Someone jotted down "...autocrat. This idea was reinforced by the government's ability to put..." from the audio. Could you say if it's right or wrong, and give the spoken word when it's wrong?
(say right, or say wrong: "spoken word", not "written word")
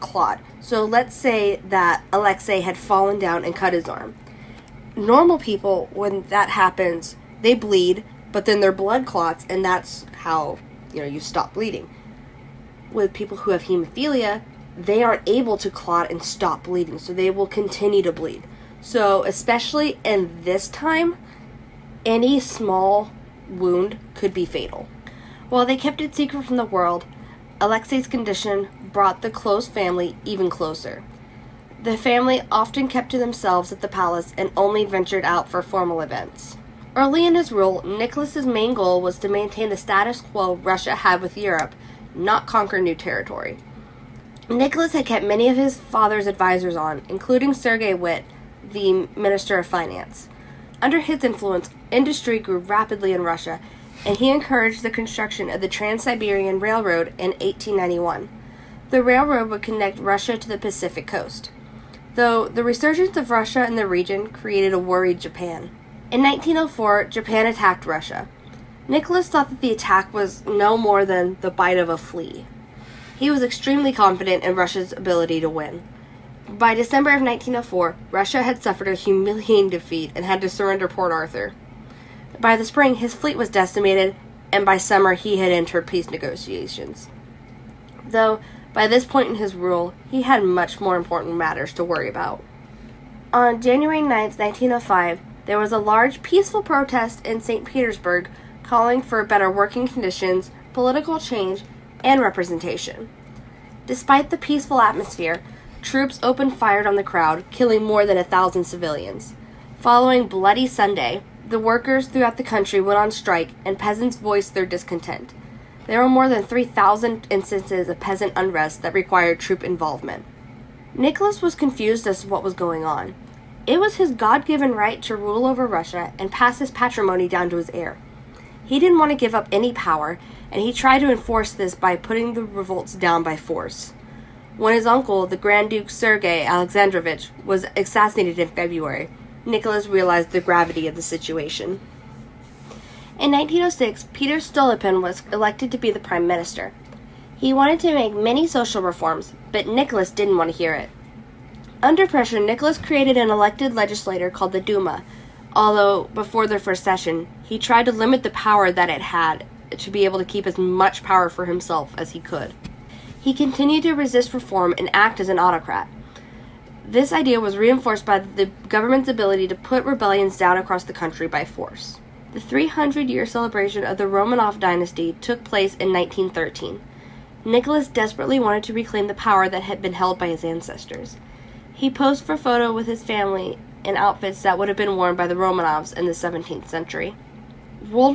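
right.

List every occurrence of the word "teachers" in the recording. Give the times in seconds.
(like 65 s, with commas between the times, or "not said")
not said.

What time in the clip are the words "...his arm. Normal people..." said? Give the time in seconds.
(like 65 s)
3 s.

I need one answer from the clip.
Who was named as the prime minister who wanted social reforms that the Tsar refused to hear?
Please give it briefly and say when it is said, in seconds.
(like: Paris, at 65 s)
Peter Stolypin, at 144 s.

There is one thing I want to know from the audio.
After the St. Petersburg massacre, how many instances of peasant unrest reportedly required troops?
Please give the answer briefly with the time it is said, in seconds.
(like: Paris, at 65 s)
3,000, at 116 s.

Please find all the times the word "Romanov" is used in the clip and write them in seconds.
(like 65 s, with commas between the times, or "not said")
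174 s, 185 s.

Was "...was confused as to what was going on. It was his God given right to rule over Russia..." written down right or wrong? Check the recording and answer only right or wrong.
right.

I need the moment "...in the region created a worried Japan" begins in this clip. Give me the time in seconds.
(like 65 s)
63 s.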